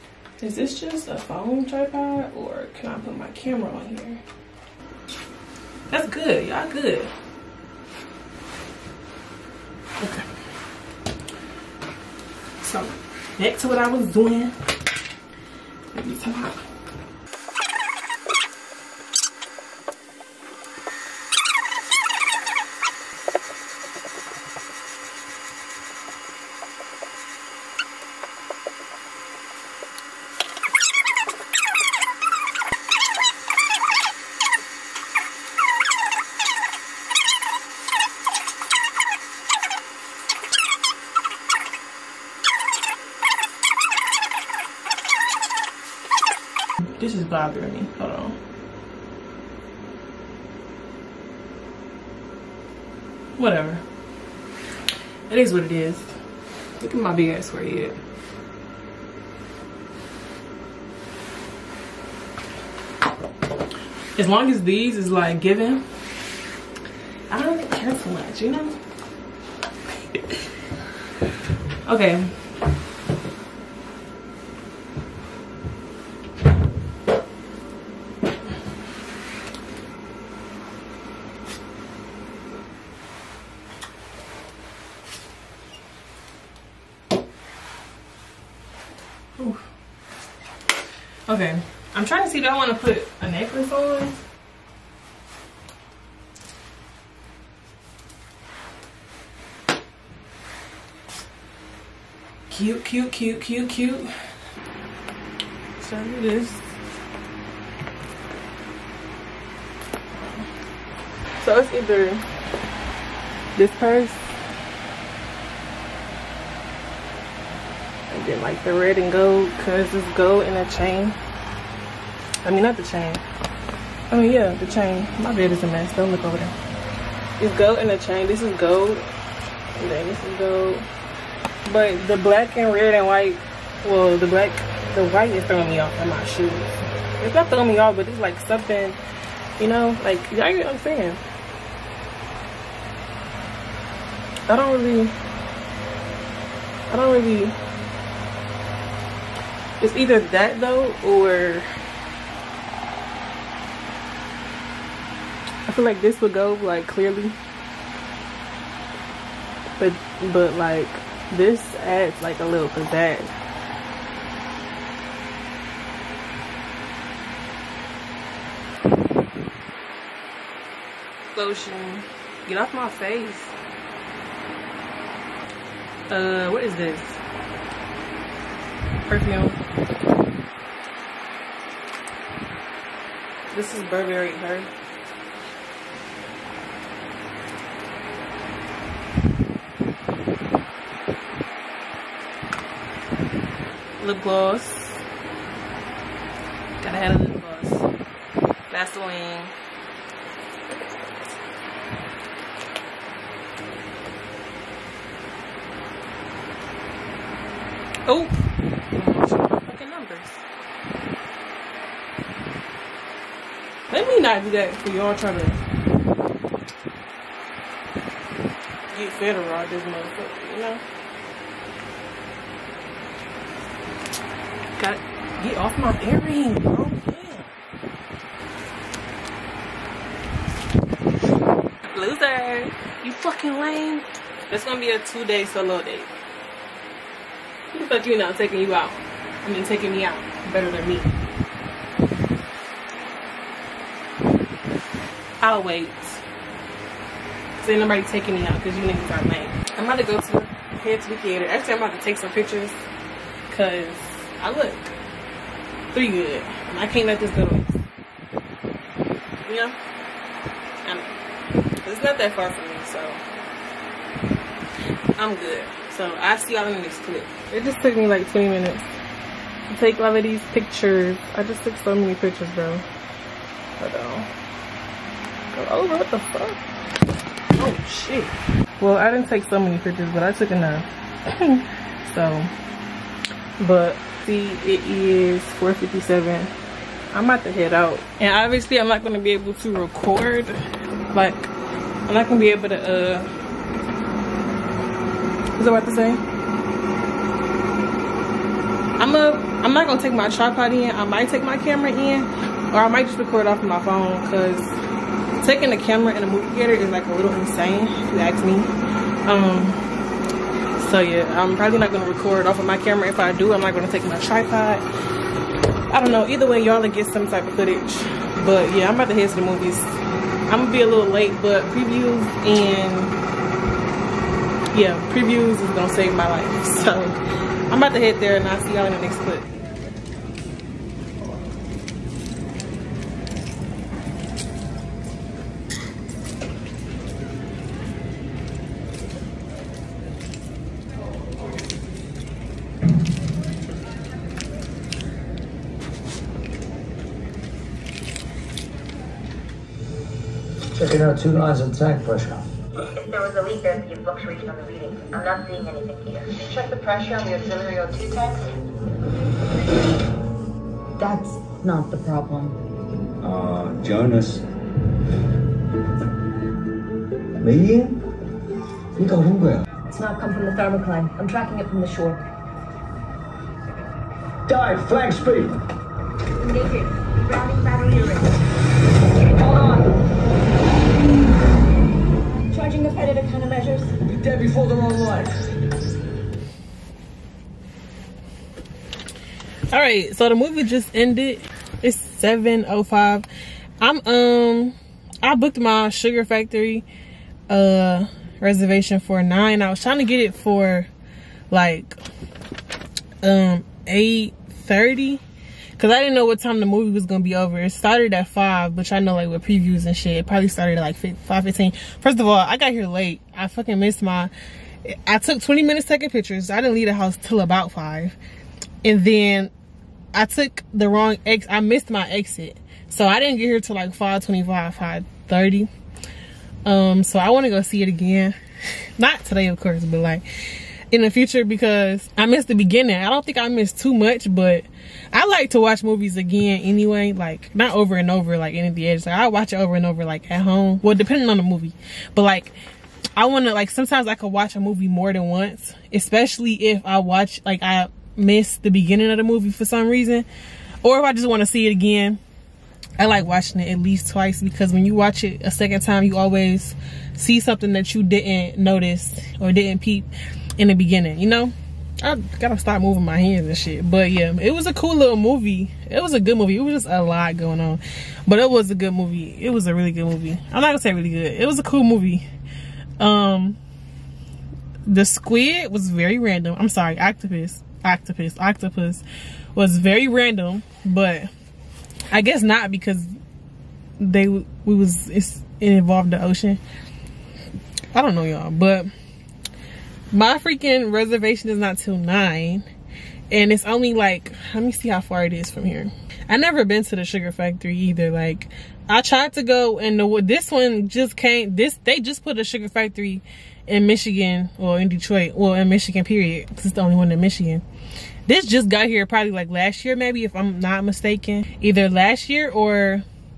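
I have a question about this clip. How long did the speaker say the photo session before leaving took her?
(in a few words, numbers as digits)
20 minutes.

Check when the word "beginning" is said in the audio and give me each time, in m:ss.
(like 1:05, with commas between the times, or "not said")
7:12, 7:28, 7:40.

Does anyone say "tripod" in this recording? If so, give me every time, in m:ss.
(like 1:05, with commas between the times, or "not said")
0:01, 5:00, 5:14.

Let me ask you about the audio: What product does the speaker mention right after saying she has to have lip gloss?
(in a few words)
Vaseline.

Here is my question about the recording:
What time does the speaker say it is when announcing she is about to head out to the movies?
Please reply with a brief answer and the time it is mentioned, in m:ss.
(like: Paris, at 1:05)
4:57, at 4:45.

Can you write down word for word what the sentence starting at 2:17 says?
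It's not throwing me off, but it's like something, you know, like, y'all get what I'm saying?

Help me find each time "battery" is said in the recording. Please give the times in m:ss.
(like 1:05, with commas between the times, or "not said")
6:17.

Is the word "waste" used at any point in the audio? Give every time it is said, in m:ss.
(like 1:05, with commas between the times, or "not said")
4:17.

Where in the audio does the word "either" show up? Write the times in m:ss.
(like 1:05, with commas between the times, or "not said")
1:51, 2:29, 5:16, 8:17, 8:31.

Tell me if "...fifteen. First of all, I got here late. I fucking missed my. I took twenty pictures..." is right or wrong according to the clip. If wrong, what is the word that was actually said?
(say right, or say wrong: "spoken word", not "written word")
wrong: "minutes", not "pictures".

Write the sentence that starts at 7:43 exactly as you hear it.
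But yeah, it was a cool little movie.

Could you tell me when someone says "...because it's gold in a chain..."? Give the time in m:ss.
1:59.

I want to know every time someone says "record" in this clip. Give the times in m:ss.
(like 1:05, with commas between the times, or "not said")
4:49, 5:03, 5:12.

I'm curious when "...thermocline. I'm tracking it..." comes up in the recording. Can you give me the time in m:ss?
6:10.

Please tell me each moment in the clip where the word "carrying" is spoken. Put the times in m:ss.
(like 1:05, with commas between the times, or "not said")
not said.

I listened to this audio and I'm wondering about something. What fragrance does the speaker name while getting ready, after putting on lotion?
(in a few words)
Burberry Her.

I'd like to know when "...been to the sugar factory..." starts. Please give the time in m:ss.
8:16.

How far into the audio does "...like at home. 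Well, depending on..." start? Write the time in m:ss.
7:20.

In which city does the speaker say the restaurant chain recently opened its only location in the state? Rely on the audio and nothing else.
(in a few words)
Detroit.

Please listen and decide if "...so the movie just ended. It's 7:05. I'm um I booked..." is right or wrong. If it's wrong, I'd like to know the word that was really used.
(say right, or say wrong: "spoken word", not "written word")
right.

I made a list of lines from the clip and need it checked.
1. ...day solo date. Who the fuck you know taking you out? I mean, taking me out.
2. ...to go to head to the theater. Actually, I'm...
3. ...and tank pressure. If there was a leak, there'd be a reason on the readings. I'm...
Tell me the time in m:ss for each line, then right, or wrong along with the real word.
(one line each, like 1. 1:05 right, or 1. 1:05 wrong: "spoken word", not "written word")
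1. 3:55 right
2. 4:09 right
3. 5:51 wrong: "fluctuation", not "reason".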